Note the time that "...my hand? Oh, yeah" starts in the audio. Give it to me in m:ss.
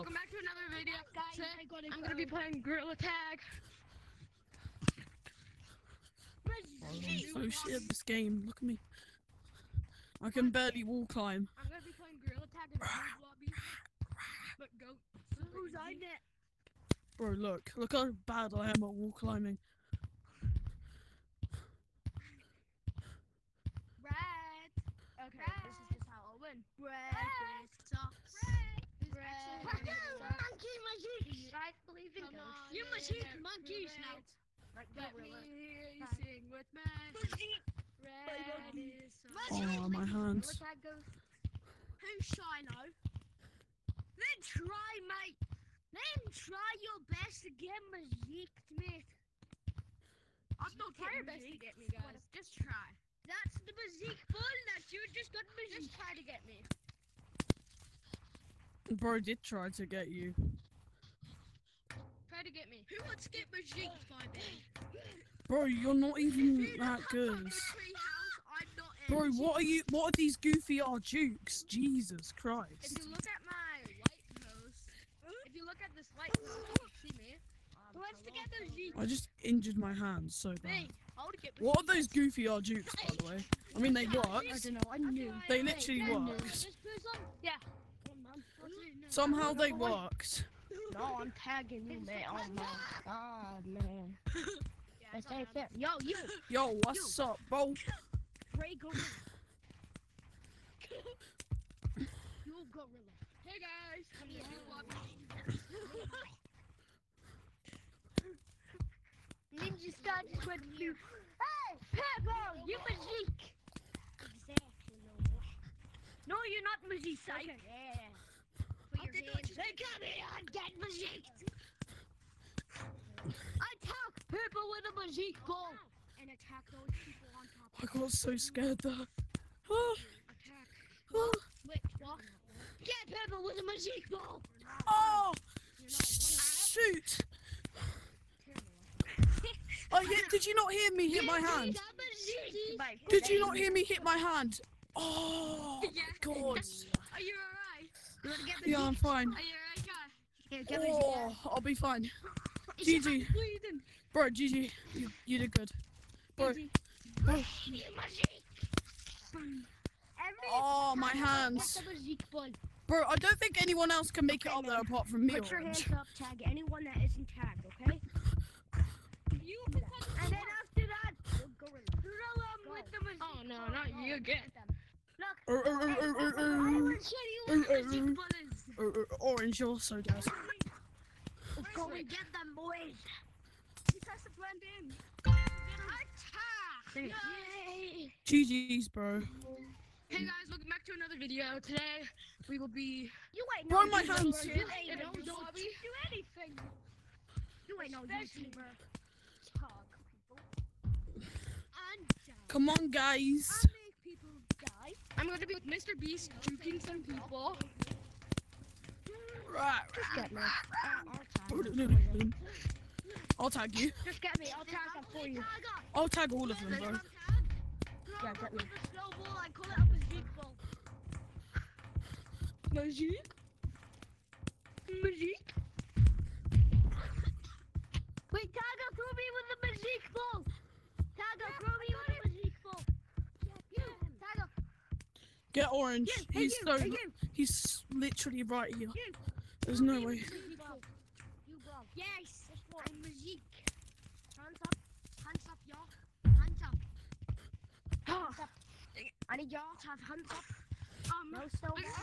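2:24.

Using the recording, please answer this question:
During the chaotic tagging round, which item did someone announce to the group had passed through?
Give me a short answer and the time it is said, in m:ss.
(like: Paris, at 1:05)
Ninja Star, at 1:49.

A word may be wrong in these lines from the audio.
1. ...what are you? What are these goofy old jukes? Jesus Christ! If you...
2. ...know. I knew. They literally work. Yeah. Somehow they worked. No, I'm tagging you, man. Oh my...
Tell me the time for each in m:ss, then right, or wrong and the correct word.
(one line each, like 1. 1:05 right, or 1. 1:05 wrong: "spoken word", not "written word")
1. 1:09 right
2. 1:24 right.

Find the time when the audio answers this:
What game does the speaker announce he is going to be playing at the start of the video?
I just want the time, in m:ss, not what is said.
0:02.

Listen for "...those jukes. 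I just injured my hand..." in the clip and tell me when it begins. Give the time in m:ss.
1:18.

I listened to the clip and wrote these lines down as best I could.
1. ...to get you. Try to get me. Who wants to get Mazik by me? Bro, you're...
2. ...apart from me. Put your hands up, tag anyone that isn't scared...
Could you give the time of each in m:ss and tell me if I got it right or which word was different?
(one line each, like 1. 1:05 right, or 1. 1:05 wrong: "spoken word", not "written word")
1. 0:59 right
2. 2:44 wrong: "tagged", not "scared".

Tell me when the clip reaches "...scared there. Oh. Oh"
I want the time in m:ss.
2:08.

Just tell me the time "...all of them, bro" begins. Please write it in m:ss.
3:36.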